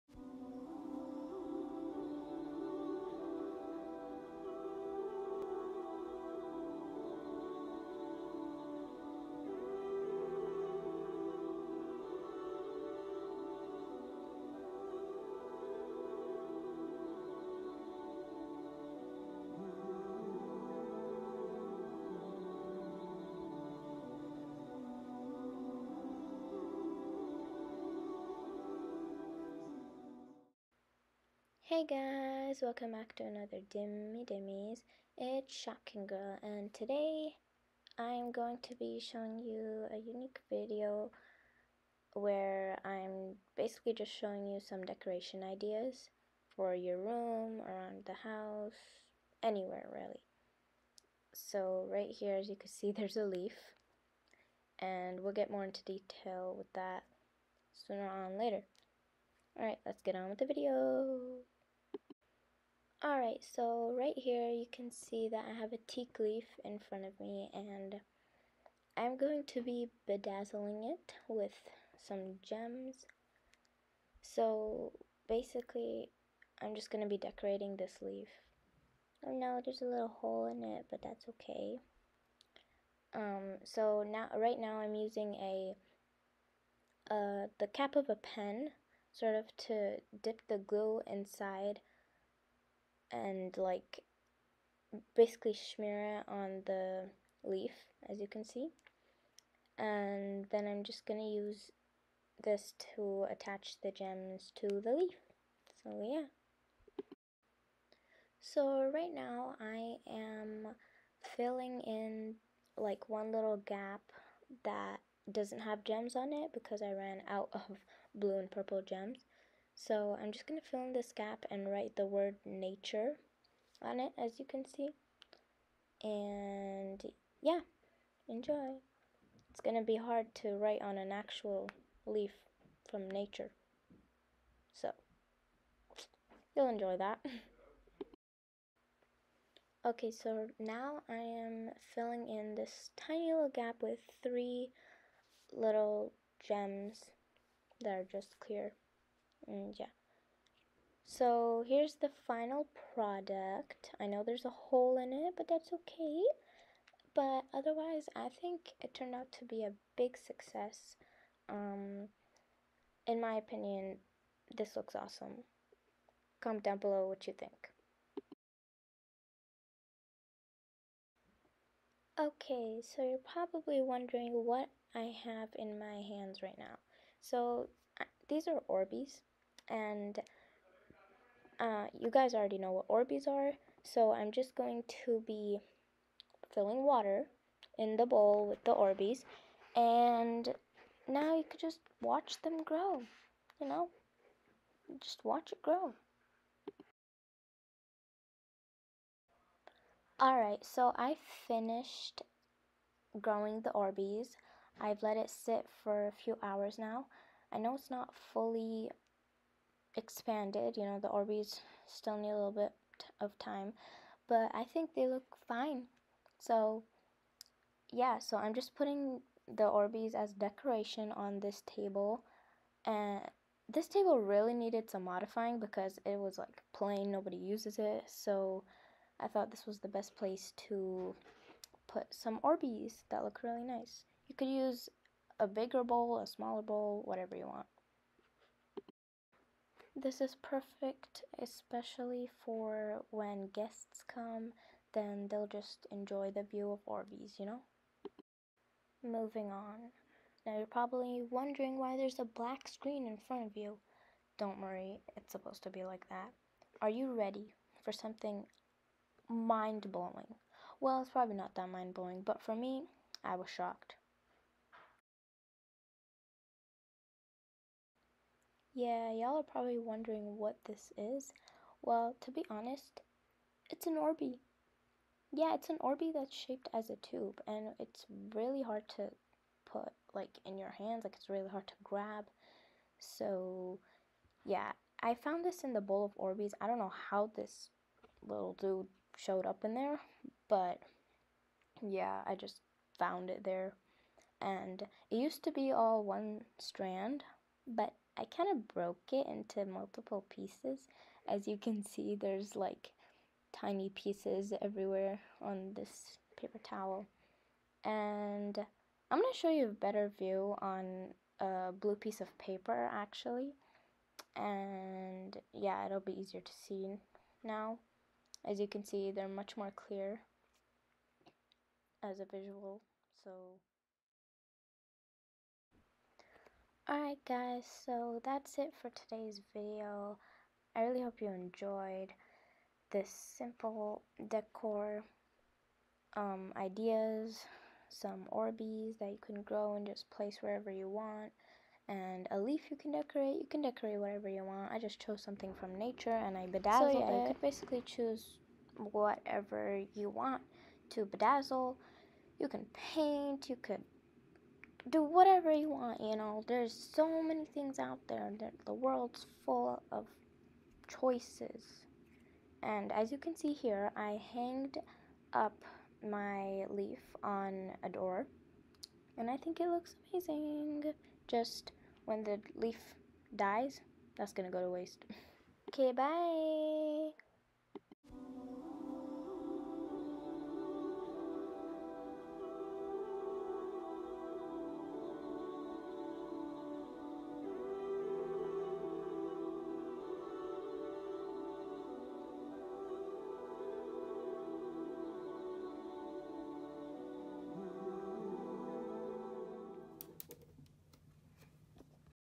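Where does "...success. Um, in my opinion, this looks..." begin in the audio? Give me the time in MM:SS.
02:40.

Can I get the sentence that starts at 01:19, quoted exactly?
Oh no, there's a little hole in it, but that's okay.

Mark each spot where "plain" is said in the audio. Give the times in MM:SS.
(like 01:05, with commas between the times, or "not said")
03:46.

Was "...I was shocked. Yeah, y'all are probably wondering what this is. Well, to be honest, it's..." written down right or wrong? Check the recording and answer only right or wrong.
right.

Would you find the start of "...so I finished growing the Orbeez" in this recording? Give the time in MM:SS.
03:20.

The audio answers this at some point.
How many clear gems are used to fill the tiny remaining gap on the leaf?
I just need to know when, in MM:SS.
02:24.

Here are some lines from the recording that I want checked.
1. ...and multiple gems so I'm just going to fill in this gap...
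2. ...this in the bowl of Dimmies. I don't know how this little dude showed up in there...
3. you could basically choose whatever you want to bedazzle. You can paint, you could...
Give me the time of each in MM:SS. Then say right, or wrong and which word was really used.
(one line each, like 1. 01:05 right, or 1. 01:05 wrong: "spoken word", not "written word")
1. 01:58 wrong: "purple", not "multiple"
2. 04:45 wrong: "Orbeez", not "Dimmies"
3. 05:47 right.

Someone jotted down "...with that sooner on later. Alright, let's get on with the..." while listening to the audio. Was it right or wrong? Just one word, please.
right.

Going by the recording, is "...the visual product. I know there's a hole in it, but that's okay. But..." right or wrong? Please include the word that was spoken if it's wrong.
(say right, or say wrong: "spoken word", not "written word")
wrong: "final", not "visual".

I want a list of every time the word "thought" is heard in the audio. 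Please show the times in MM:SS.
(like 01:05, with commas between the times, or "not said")
03:49.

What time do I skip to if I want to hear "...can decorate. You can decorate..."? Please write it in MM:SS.
05:42.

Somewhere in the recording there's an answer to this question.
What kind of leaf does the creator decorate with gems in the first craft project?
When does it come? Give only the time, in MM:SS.
01:05.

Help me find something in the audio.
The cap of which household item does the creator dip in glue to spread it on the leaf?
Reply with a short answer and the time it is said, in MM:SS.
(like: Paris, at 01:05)
a pen, at 01:28.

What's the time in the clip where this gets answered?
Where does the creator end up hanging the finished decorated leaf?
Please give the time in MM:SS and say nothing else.
06:07.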